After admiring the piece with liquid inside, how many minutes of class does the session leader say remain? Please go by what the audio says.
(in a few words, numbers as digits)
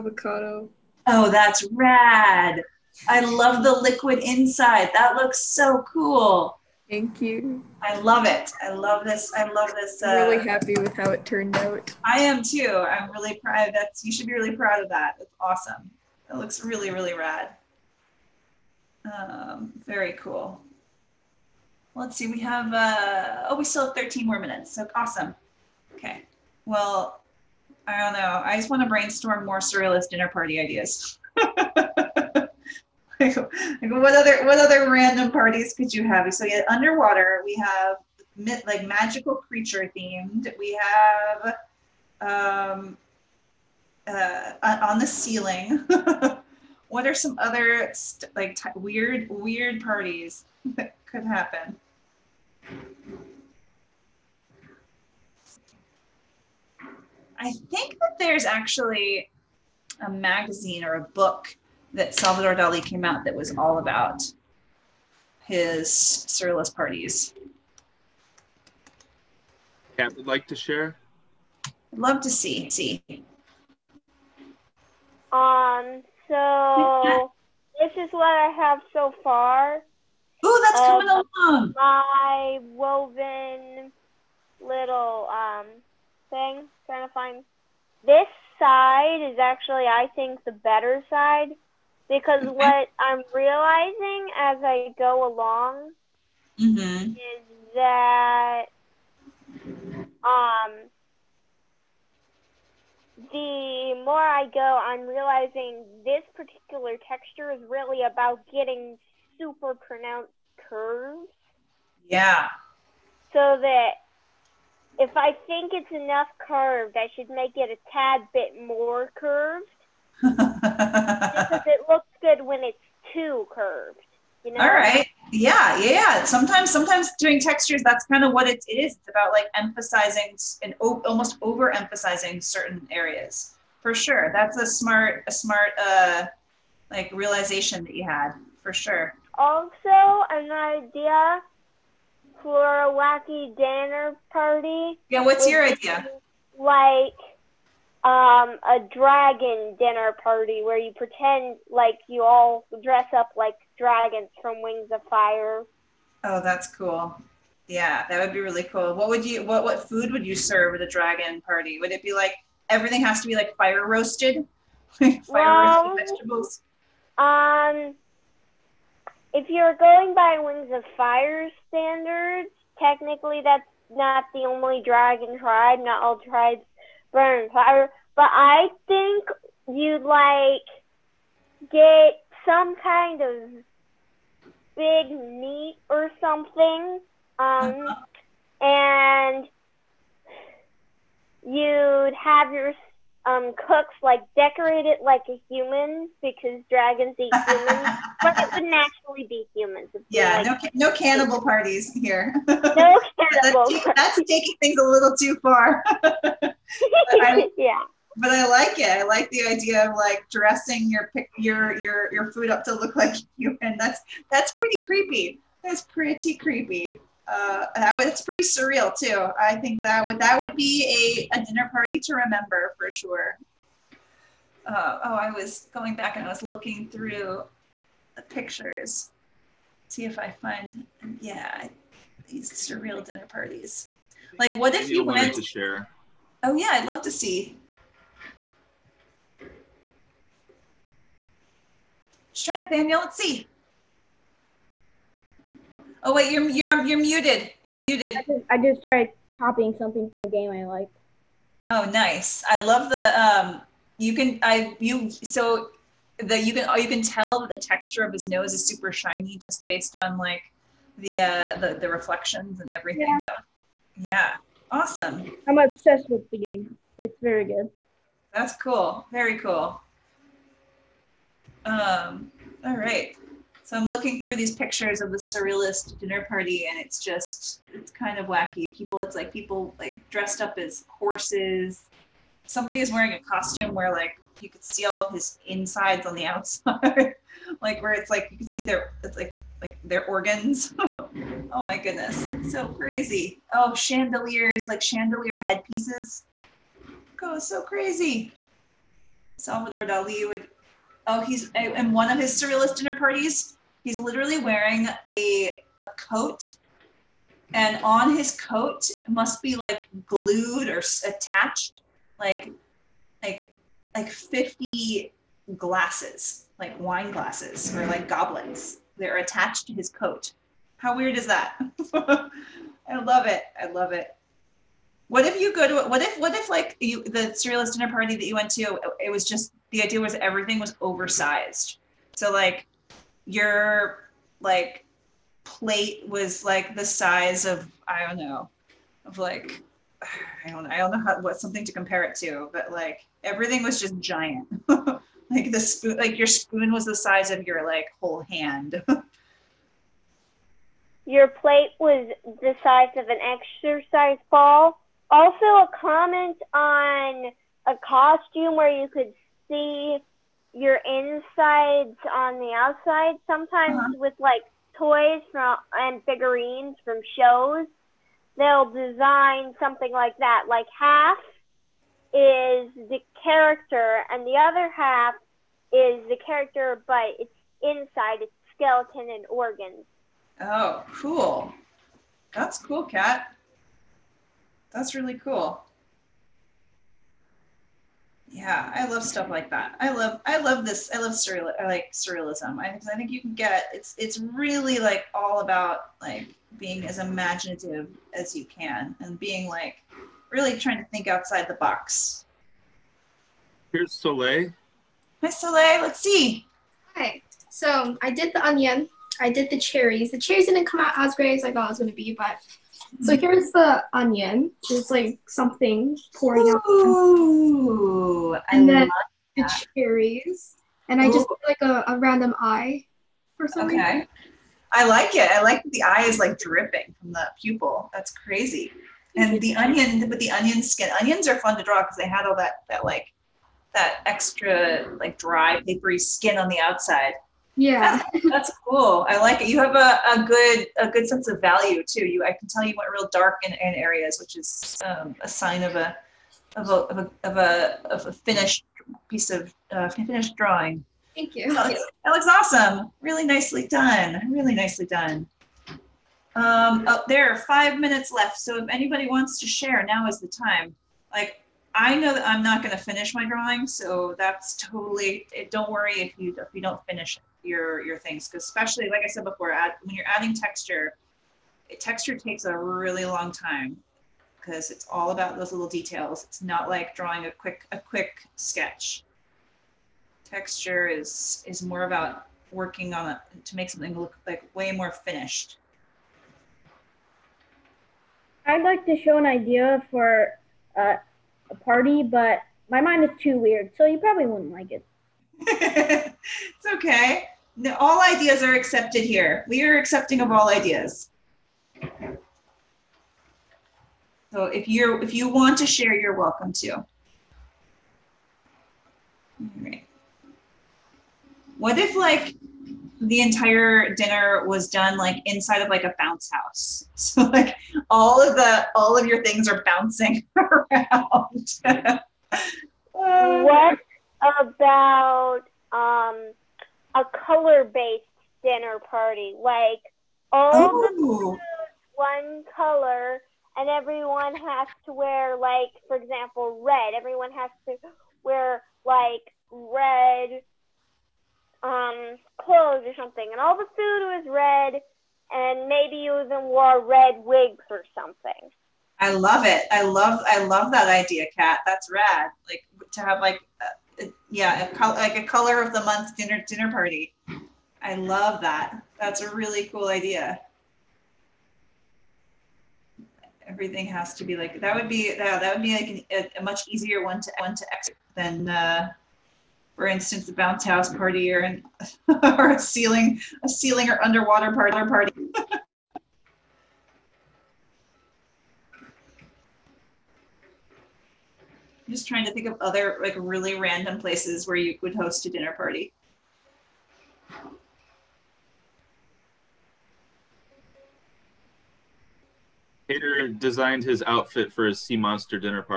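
13.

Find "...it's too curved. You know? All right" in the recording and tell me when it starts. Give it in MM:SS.
02:02.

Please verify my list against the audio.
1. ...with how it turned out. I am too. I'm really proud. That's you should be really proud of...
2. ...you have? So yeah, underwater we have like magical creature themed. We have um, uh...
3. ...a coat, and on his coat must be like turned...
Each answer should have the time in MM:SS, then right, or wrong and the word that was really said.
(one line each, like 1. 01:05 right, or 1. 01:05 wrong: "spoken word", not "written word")
1. 00:10 right
2. 00:35 right
3. 05:05 wrong: "glued", not "turned".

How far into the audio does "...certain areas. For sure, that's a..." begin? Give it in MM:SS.
02:12.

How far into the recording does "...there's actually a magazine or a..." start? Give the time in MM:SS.
00:58.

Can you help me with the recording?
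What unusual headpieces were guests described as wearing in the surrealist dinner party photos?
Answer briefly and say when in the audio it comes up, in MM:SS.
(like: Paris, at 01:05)
chandeliers, at 04:54.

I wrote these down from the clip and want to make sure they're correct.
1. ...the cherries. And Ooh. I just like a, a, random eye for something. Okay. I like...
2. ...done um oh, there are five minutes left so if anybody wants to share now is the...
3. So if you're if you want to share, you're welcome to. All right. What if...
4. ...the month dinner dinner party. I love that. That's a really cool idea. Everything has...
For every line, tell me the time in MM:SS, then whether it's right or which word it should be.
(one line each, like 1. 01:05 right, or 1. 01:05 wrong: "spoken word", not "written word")
1. 06:59 right
2. 07:34 right
3. 08:24 right
4. 09:15 right.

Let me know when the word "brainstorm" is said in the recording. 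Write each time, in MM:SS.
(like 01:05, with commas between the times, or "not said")
00:28.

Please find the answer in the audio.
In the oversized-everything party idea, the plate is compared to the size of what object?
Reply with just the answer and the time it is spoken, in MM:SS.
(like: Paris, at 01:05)
an exercise ball, at 05:53.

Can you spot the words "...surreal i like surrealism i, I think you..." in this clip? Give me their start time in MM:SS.
06:31.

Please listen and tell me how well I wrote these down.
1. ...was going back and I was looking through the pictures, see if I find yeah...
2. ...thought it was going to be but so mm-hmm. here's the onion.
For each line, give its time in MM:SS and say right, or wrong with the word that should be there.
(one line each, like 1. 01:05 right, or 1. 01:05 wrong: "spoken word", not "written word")
1. 03:45 right
2. 06:51 right.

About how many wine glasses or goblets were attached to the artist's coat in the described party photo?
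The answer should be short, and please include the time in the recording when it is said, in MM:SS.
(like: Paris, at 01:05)
50, at 05:14.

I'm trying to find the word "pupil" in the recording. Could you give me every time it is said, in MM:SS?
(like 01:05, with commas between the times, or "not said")
07:07.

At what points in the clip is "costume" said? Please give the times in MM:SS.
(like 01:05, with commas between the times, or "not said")
04:43, 05:57.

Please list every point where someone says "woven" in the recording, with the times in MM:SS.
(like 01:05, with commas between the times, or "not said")
01:22.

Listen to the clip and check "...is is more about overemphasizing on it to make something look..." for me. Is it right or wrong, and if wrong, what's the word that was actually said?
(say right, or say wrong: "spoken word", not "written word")
wrong: "working", not "overemphasizing".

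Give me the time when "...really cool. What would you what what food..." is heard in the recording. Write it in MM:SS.
02:38.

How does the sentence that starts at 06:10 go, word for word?
Like half is the character, and the other half is the character, but it's inside.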